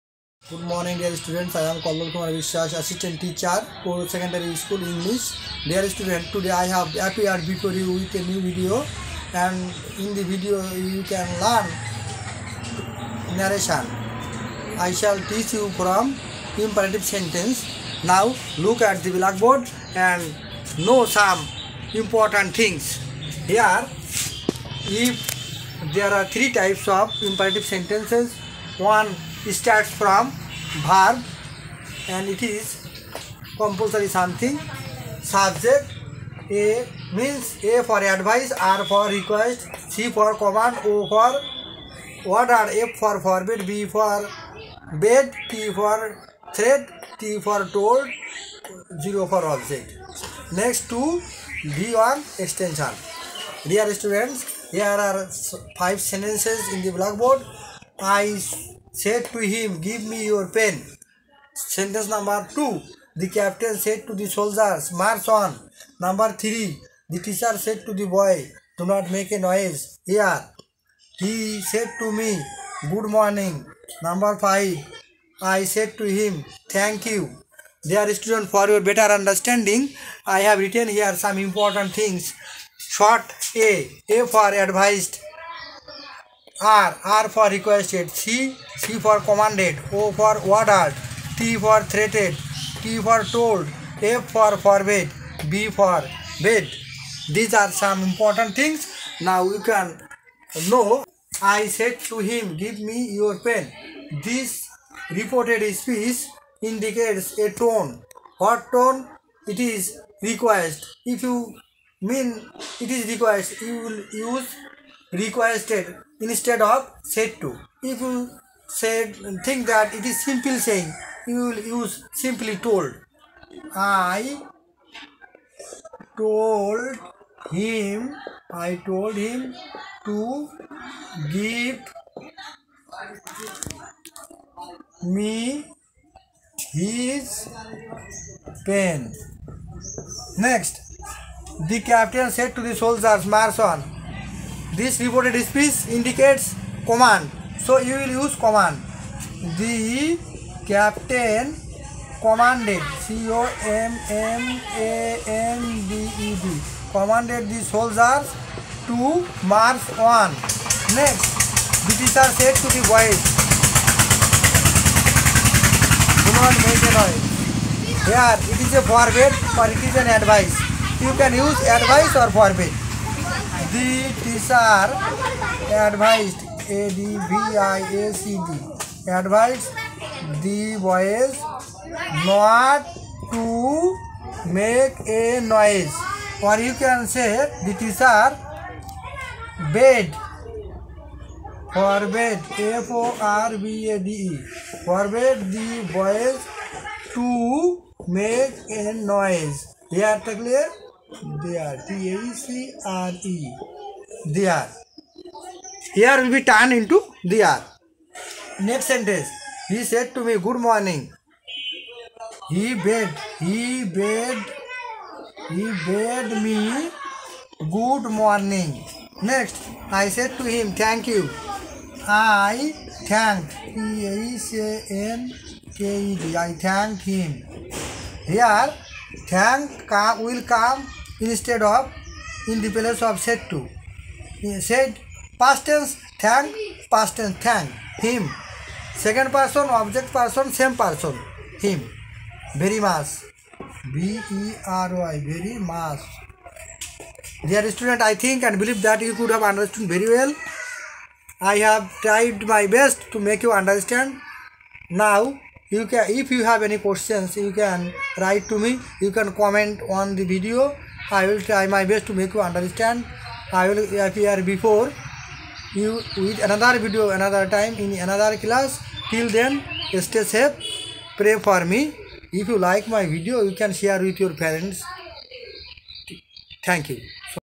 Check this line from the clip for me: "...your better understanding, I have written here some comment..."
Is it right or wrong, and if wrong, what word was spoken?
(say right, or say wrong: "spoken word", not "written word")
wrong: "important", not "comment".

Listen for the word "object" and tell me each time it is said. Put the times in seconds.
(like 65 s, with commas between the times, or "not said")
49 s, 239 s.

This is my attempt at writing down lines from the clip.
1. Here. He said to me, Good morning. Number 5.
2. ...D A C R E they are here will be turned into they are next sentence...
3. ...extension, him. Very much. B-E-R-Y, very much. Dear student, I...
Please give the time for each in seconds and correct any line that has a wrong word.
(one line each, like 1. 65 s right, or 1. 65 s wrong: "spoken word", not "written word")
1. 70 s right
2. 201 s right
3. 240 s wrong: "person", not "extension".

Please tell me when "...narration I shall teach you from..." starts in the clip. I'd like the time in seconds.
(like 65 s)
13 s.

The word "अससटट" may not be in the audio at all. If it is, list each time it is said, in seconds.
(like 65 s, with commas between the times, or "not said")
2 s.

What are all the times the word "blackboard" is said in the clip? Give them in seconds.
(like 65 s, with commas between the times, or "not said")
19 s, 56 s.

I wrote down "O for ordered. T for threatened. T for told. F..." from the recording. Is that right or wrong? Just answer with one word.
right.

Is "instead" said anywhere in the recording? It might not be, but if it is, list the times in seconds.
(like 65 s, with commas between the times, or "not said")
116 s, 231 s.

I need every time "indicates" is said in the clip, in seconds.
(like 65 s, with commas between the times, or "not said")
106 s, 145 s.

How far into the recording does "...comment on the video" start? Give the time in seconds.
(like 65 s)
259 s.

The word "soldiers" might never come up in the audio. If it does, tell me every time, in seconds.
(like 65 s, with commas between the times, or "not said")
64 s, 142 s, 157 s.